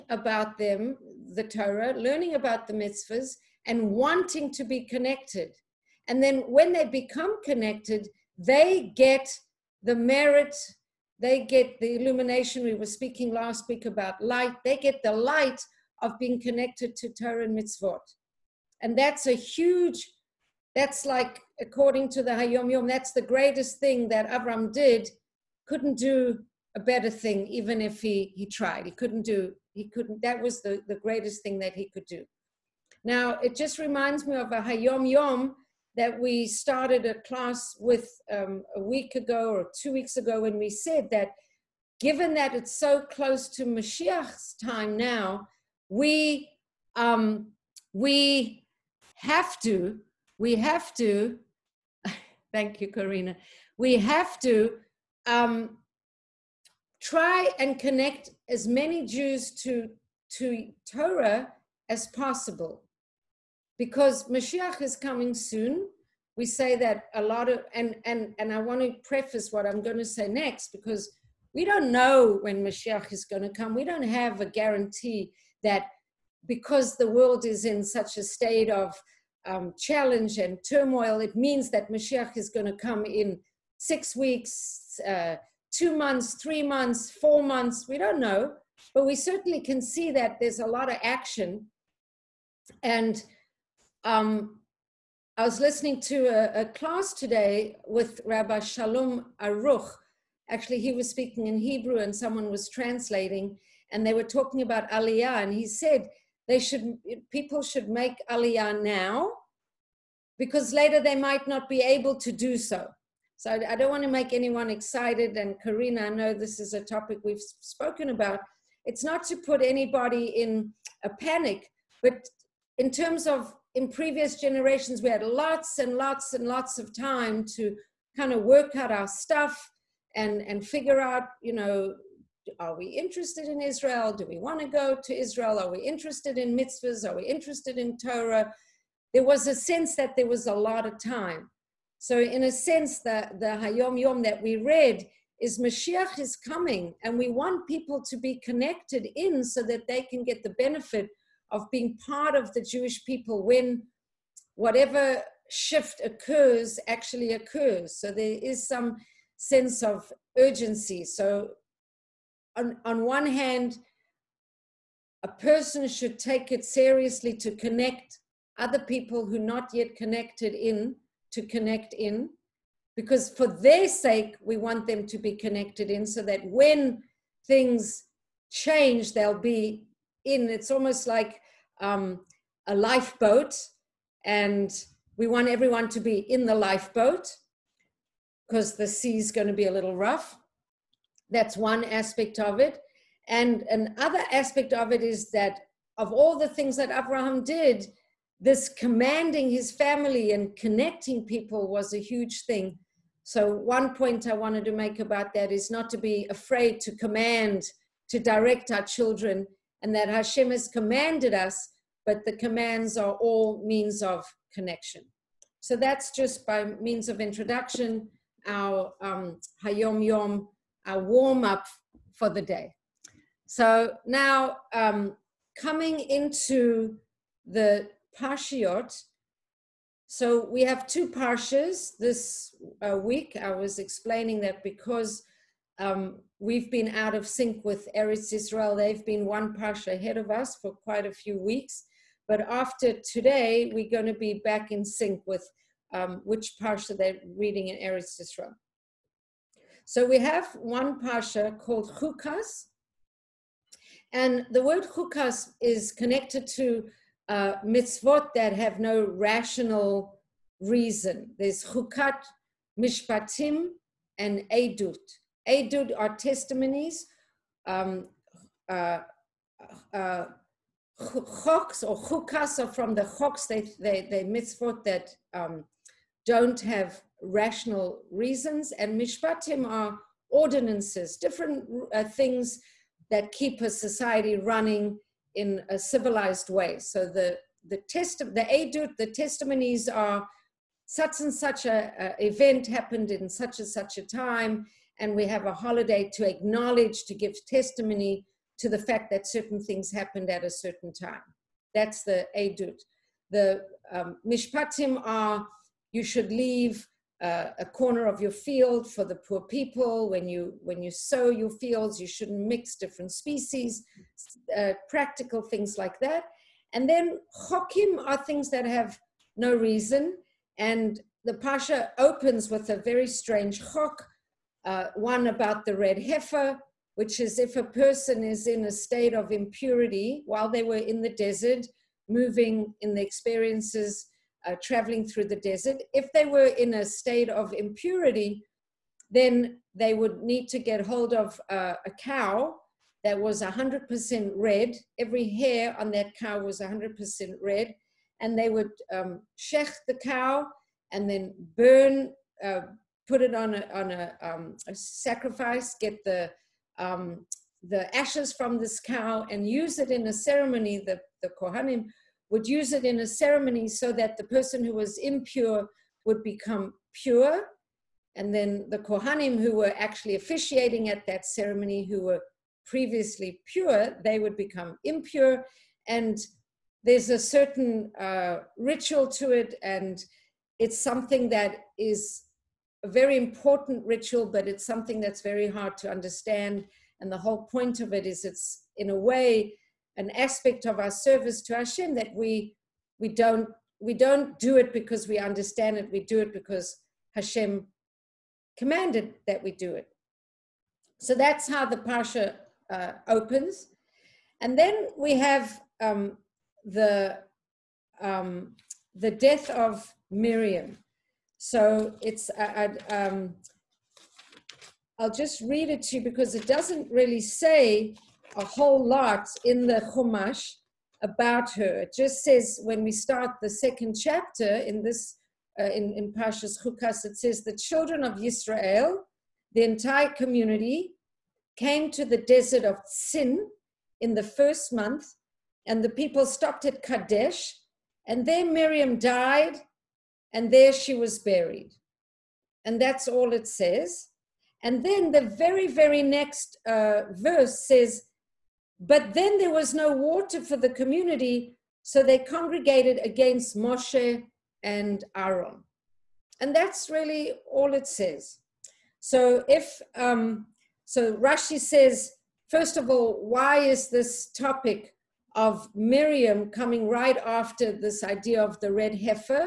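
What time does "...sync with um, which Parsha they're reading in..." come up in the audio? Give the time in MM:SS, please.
04:04.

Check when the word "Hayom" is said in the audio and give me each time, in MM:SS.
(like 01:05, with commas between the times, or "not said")
00:22, 00:34, 02:23, 03:39.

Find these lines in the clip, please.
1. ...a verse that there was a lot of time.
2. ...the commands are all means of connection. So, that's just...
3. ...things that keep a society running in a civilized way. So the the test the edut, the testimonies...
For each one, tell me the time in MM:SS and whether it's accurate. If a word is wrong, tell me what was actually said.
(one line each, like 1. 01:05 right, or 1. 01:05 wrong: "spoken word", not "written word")
1. 02:19 wrong: "sense", not "verse"
2. 03:32 right
3. 04:42 right.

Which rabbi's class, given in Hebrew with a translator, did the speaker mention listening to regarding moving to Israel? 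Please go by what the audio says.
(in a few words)
Rabbi Shalom Arush.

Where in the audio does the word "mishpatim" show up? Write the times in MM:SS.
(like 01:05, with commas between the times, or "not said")
04:22, 04:39, 05:04.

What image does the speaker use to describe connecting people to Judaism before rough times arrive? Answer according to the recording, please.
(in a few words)
a lifeboat.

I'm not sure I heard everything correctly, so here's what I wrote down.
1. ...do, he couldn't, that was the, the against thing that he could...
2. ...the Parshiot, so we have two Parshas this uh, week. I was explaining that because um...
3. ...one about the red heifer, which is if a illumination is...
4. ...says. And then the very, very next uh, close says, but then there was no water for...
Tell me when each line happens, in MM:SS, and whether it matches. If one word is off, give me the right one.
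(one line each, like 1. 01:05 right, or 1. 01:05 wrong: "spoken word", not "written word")
1. 00:29 wrong: "greatest", not "against"
2. 03:47 right
3. 05:24 wrong: "person", not "illumination"
4. 07:23 wrong: "verse", not "close".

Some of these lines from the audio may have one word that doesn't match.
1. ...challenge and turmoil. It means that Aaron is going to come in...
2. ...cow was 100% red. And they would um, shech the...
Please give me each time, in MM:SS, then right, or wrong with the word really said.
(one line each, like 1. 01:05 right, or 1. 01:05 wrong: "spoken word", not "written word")
1. 01:19 wrong: "Mashiach", not "Aaron"
2. 05:46 right.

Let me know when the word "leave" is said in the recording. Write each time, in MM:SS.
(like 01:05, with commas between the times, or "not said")
05:06.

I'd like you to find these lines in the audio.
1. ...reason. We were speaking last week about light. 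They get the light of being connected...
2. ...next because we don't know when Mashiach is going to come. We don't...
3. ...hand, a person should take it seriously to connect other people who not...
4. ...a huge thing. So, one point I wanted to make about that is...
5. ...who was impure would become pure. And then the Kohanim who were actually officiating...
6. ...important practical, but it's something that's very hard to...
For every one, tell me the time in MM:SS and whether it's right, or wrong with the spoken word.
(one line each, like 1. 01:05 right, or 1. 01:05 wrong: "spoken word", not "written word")
1. 00:11 wrong: "illumination", not "reason"
2. 01:10 right
3. 02:43 right
4. 03:21 right
5. 06:04 right
6. 06:23 wrong: "ritual", not "practical".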